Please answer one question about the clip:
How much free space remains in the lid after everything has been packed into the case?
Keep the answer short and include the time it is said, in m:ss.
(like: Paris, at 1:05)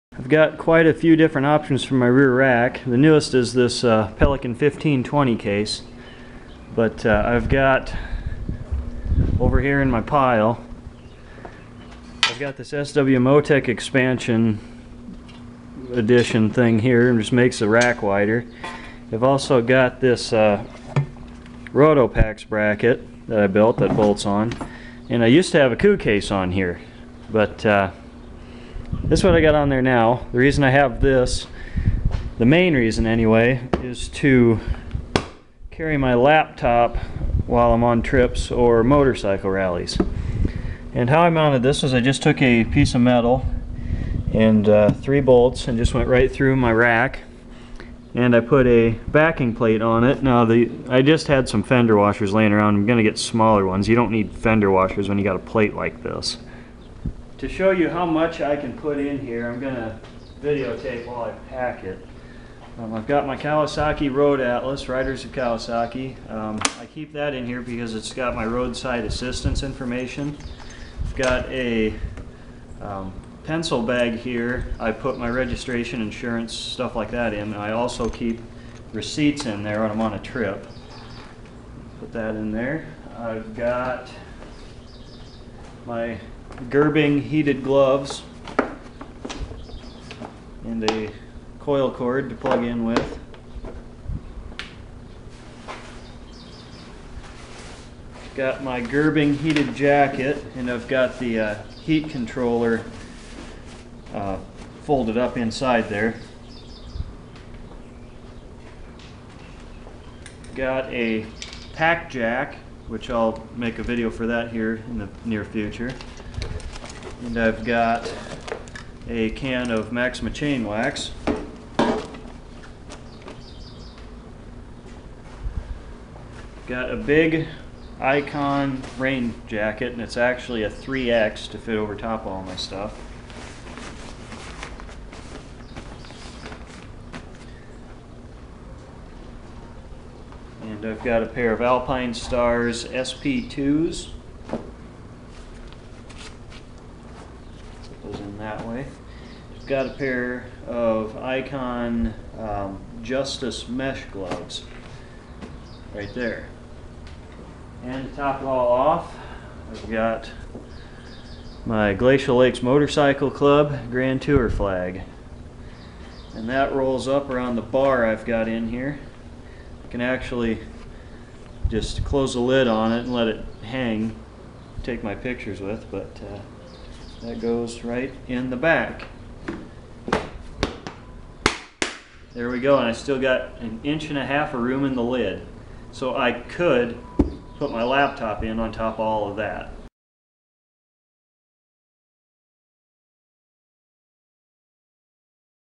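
an inch and a half, at 3:03.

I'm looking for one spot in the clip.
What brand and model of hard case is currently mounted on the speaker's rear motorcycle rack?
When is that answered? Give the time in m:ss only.
0:04.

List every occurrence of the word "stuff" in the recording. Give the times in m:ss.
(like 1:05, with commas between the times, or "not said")
1:16, 2:12.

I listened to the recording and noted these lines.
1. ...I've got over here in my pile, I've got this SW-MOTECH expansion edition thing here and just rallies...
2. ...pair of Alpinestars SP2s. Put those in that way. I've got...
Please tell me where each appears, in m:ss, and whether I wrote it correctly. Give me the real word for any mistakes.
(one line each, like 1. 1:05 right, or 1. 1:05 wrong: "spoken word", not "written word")
1. 0:07 wrong: "makes", not "rallies"
2. 2:21 right.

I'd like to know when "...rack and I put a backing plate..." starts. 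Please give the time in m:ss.
0:46.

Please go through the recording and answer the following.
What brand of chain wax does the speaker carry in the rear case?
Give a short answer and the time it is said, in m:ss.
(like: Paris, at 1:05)
Maxima, at 1:59.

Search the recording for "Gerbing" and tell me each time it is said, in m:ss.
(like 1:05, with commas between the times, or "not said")
1:26, 1:38.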